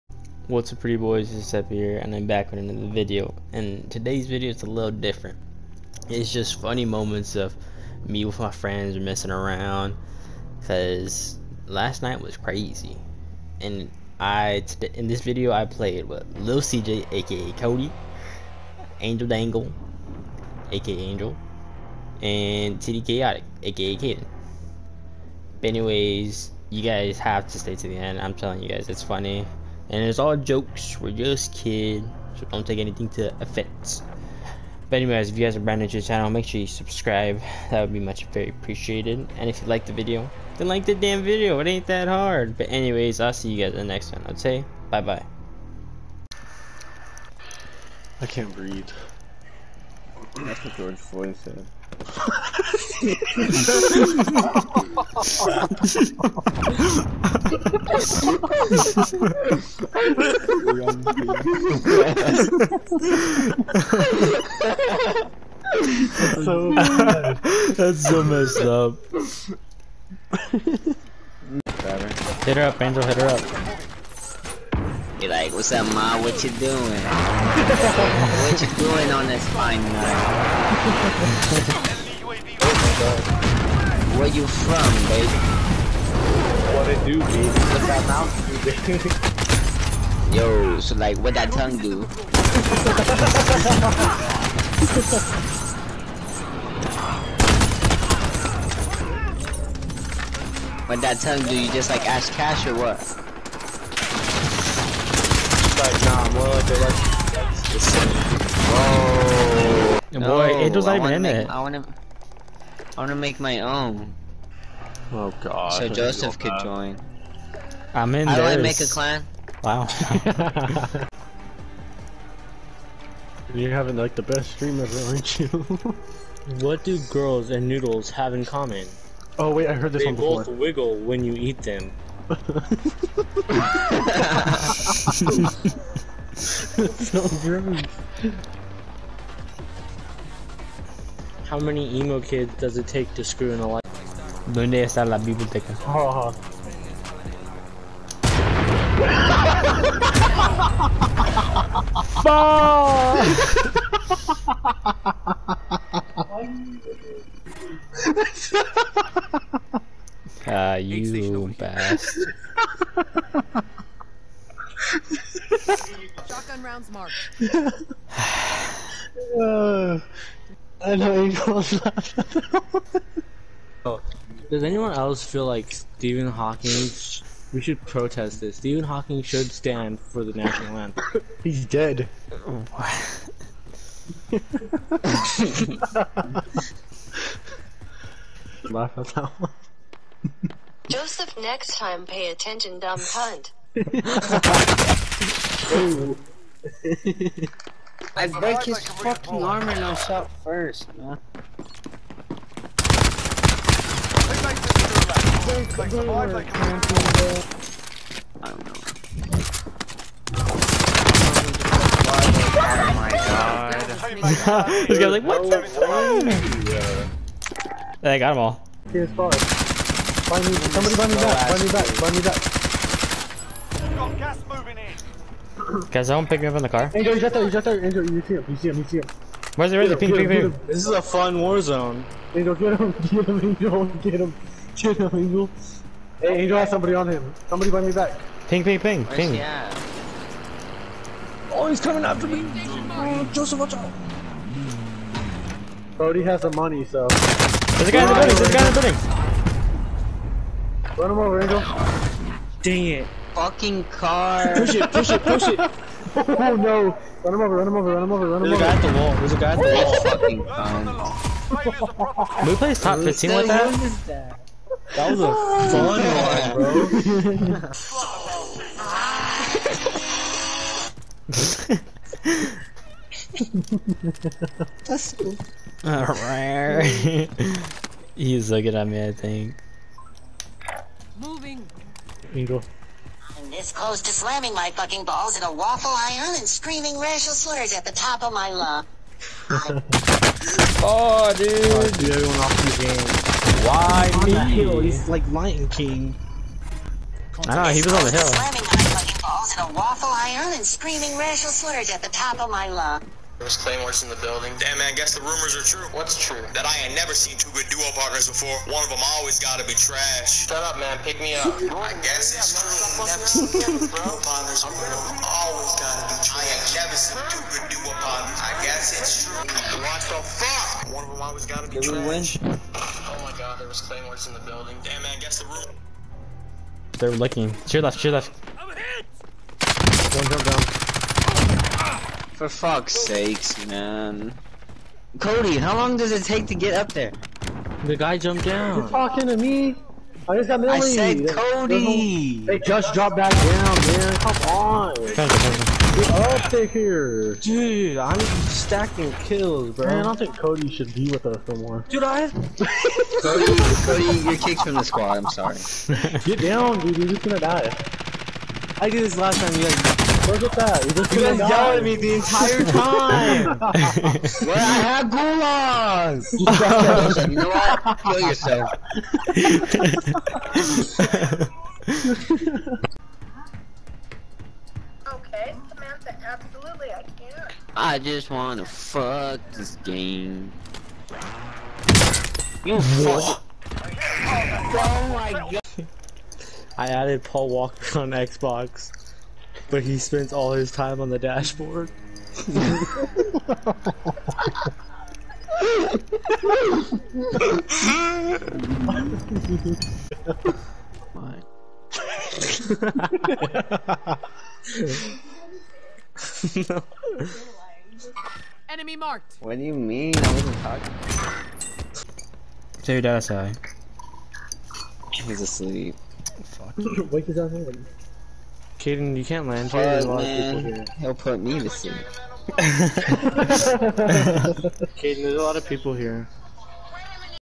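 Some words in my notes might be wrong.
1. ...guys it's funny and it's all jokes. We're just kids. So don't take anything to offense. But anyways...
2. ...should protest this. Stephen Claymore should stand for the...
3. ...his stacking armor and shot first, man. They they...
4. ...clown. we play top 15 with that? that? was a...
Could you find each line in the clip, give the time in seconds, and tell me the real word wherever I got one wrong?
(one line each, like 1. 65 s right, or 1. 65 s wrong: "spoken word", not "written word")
1. 28 s right
2. 177 s wrong: "Hawking", not "Claymore"
3. 198 s wrong: "fucking", not "stacking"
4. 261 s right.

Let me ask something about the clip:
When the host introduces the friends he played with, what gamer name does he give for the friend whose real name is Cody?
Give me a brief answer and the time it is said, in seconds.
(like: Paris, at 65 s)
Lil CJ, at 16 s.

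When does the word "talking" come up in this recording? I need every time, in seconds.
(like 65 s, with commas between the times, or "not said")
338 s, 410 s.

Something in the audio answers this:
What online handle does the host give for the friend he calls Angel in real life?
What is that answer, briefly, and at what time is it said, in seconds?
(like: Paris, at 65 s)
Angel Dangle, at 18 s.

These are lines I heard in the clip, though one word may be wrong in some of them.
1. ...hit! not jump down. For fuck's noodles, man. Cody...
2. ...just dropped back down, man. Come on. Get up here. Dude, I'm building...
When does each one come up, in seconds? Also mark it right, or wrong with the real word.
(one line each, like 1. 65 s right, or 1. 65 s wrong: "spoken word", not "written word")
1. 328 s wrong: "sakes", not "noodles"
2. 342 s wrong: "stacking", not "building".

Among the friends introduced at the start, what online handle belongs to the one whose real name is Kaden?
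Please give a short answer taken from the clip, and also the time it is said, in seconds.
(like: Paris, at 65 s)
TD Chaotic, at 22 s.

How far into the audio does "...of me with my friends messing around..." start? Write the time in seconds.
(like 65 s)
7 s.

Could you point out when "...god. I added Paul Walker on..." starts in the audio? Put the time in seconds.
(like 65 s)
385 s.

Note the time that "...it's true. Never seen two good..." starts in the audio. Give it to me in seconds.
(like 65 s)
312 s.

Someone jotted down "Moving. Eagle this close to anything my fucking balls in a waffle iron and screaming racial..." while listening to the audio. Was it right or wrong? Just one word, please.
wrong.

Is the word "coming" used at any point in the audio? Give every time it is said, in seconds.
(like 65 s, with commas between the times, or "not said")
241 s.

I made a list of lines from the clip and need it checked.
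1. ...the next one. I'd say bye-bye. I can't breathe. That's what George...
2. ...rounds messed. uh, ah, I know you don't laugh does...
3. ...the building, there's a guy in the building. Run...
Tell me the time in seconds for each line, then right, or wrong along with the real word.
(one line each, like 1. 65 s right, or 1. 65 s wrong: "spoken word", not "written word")
1. 43 s right
2. 166 s wrong: "marked", not "messed"
3. 248 s right.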